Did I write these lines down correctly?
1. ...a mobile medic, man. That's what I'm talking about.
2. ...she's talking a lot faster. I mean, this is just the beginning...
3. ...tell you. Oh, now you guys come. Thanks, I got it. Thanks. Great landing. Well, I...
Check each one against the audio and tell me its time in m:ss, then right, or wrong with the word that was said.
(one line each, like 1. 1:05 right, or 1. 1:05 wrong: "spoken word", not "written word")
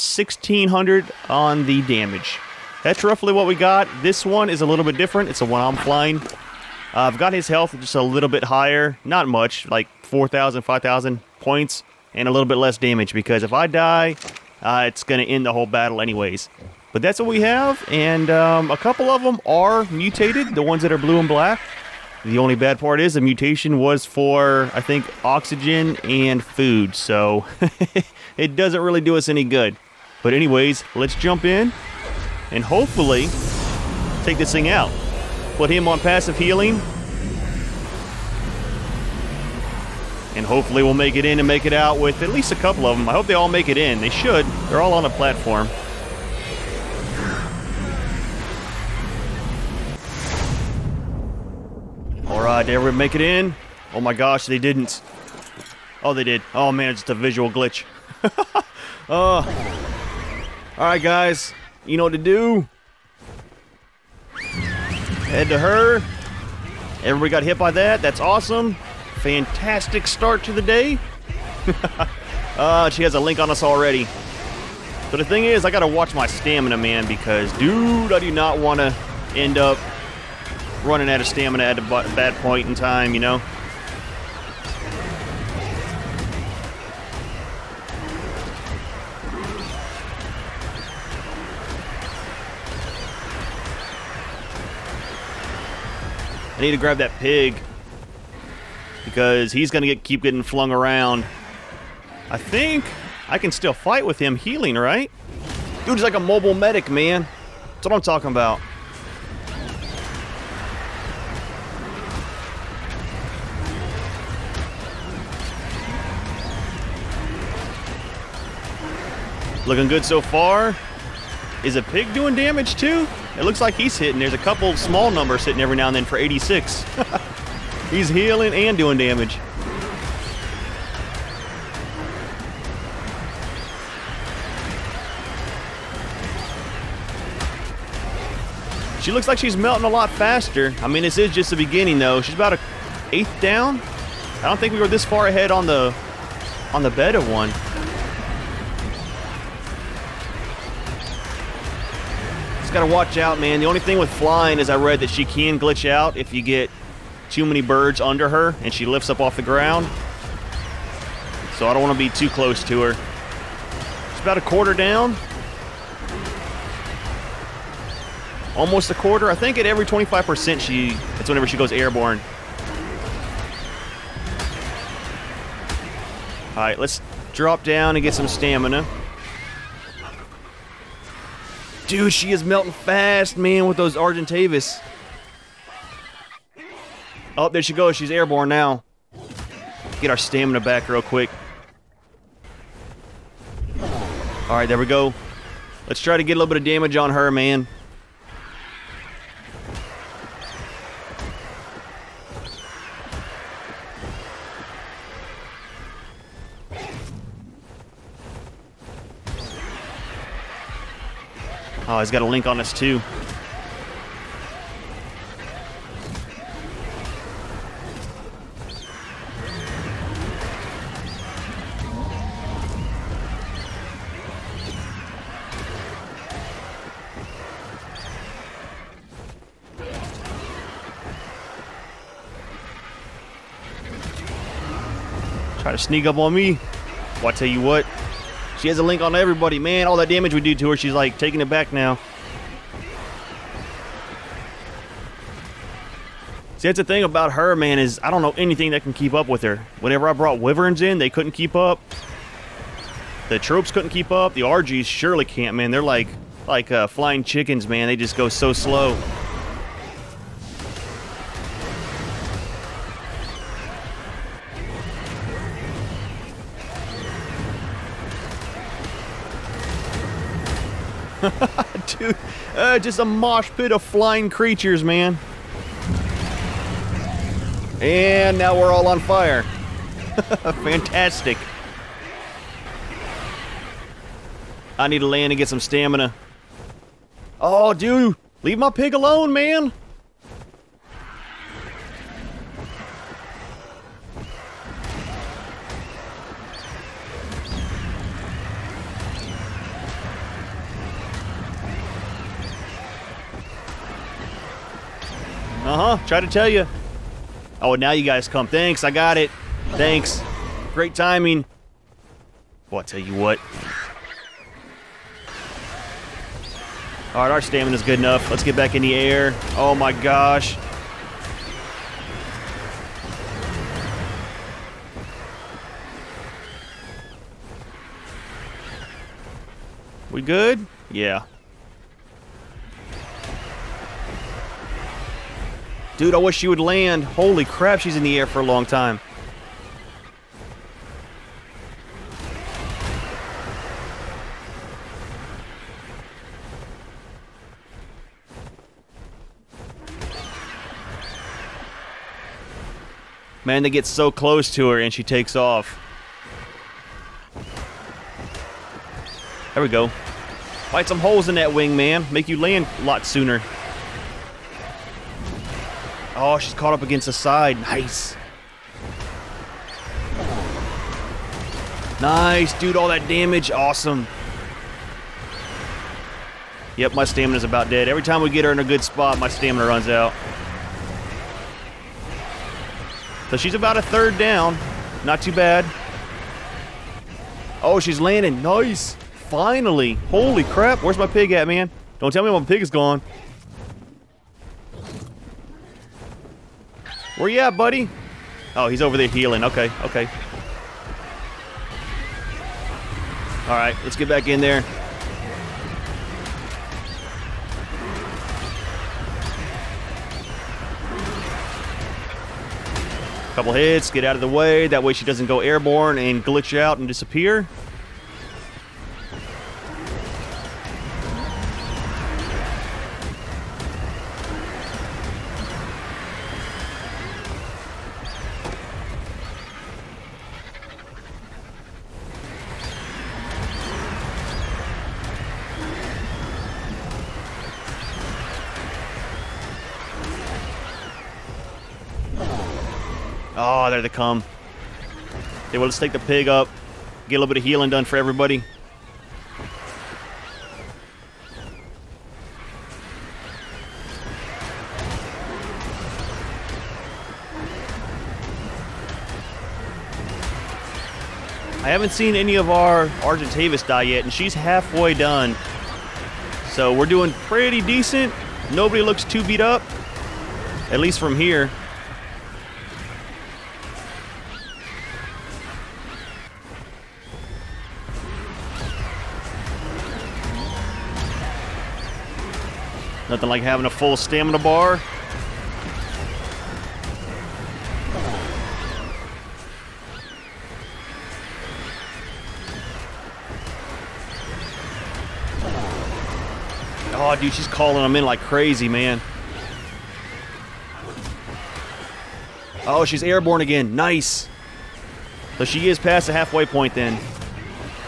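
1. 1:46 right
2. 2:19 wrong: "melting", not "talking"
3. 5:06 wrong: "timing", not "landing".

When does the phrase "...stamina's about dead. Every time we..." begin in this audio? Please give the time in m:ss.
6:17.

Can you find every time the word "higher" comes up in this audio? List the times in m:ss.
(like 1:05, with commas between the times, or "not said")
0:08.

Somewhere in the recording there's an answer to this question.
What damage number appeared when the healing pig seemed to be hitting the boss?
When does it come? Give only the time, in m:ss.
2:06.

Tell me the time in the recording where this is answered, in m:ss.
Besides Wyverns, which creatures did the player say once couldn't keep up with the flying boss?
4:13.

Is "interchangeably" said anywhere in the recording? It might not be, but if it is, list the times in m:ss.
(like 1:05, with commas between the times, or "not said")
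not said.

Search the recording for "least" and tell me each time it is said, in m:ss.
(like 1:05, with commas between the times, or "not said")
0:42, 7:50.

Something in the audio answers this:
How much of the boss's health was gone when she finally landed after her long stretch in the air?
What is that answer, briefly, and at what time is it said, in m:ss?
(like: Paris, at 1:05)
a third, at 6:23.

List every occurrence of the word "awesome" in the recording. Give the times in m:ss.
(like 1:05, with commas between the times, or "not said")
1:08, 6:13.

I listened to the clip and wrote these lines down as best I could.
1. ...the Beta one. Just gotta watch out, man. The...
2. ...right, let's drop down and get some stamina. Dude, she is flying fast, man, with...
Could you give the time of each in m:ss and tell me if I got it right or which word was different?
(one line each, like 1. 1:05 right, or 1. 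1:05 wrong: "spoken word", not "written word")
1. 2:26 right
2. 2:56 wrong: "melting", not "flying".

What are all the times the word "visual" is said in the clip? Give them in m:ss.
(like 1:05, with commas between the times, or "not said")
0:57.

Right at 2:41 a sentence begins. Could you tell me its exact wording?
So I don't want to be too close to her.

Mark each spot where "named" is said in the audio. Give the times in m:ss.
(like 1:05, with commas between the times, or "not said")
not said.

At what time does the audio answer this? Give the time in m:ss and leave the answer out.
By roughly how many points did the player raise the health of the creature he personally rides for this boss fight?
0:10.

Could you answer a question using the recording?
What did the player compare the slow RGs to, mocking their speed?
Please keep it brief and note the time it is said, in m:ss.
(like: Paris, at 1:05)
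flying chickens, at 4:16.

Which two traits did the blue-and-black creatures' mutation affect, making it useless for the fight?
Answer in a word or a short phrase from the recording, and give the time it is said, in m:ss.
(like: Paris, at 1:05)
oxygen and food, at 0:25.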